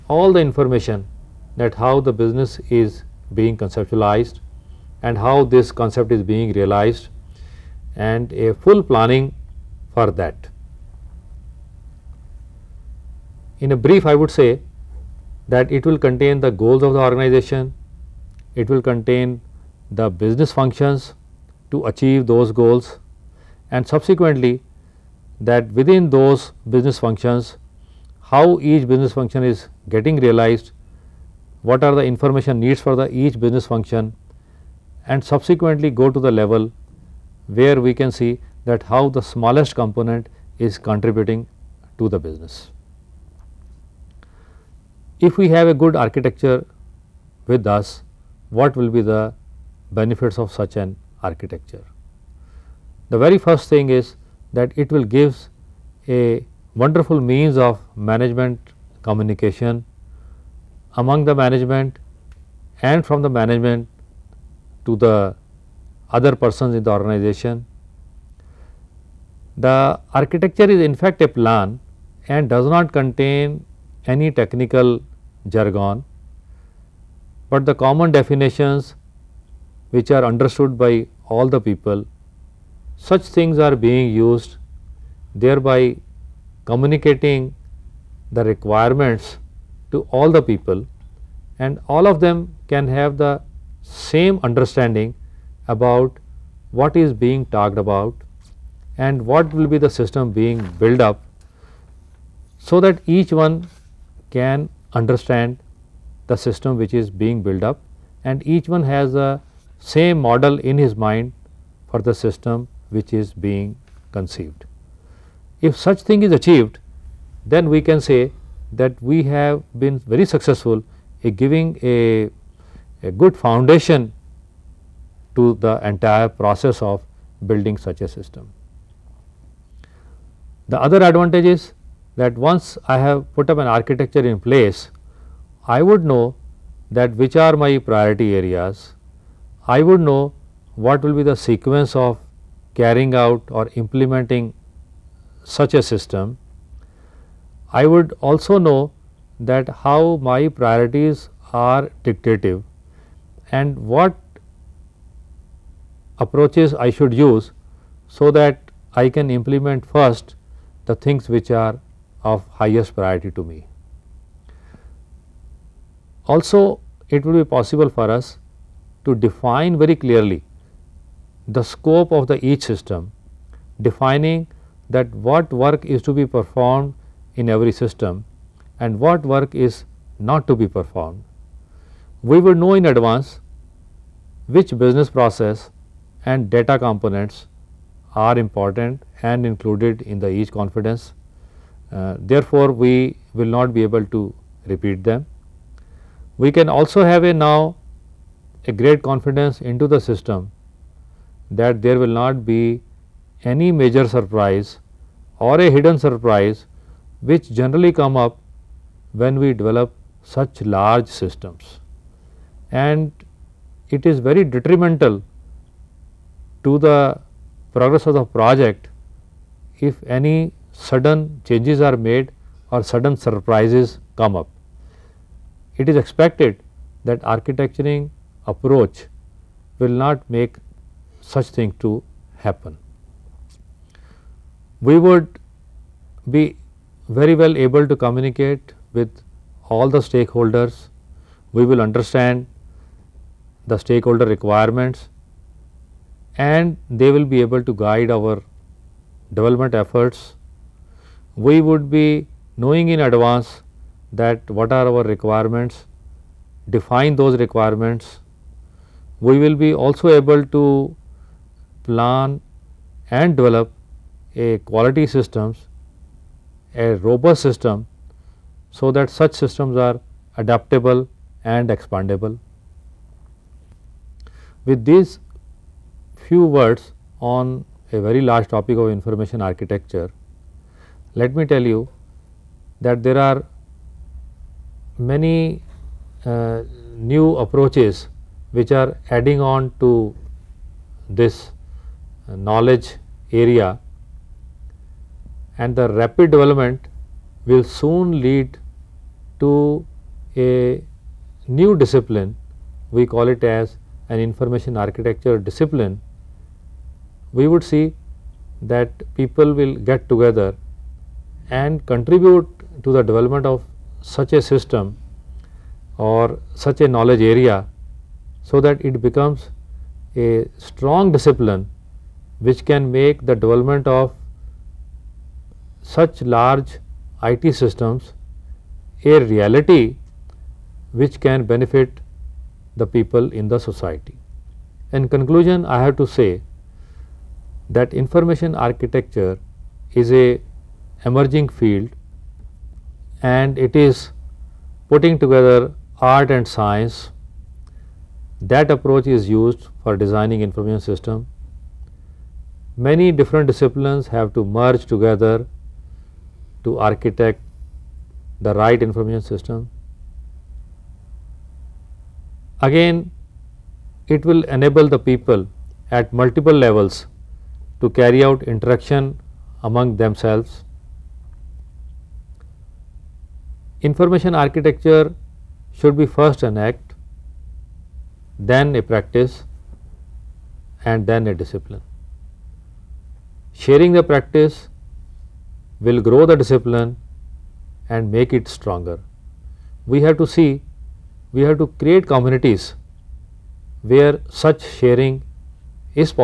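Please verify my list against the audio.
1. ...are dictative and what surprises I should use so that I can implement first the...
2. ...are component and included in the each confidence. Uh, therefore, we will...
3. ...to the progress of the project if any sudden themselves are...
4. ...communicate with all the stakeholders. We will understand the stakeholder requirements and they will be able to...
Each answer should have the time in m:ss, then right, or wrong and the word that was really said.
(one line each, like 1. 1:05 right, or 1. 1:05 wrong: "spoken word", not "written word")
1. 2:31 wrong: "approaches", not "surprises"
2. 3:08 wrong: "important", not "component"
3. 3:36 wrong: "changes", not "themselves"
4. 3:57 right.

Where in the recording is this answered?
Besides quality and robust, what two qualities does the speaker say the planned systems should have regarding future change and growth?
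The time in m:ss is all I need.
4:30.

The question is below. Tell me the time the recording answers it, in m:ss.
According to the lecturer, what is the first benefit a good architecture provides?
0:57.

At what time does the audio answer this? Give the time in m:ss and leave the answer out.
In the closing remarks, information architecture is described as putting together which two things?
5:46.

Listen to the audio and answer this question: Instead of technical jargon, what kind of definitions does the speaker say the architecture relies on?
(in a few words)
Common definitions.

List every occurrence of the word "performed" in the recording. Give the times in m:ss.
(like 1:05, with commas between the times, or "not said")
2:56, 3:00.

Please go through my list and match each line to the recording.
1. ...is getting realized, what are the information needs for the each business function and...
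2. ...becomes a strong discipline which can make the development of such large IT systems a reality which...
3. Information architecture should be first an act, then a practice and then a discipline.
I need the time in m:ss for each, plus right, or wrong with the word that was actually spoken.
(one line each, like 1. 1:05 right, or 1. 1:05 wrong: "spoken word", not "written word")
1. 0:29 right
2. 5:19 right
3. 6:13 right.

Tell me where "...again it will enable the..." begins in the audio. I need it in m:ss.
6:02.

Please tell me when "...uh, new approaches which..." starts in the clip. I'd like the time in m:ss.
4:46.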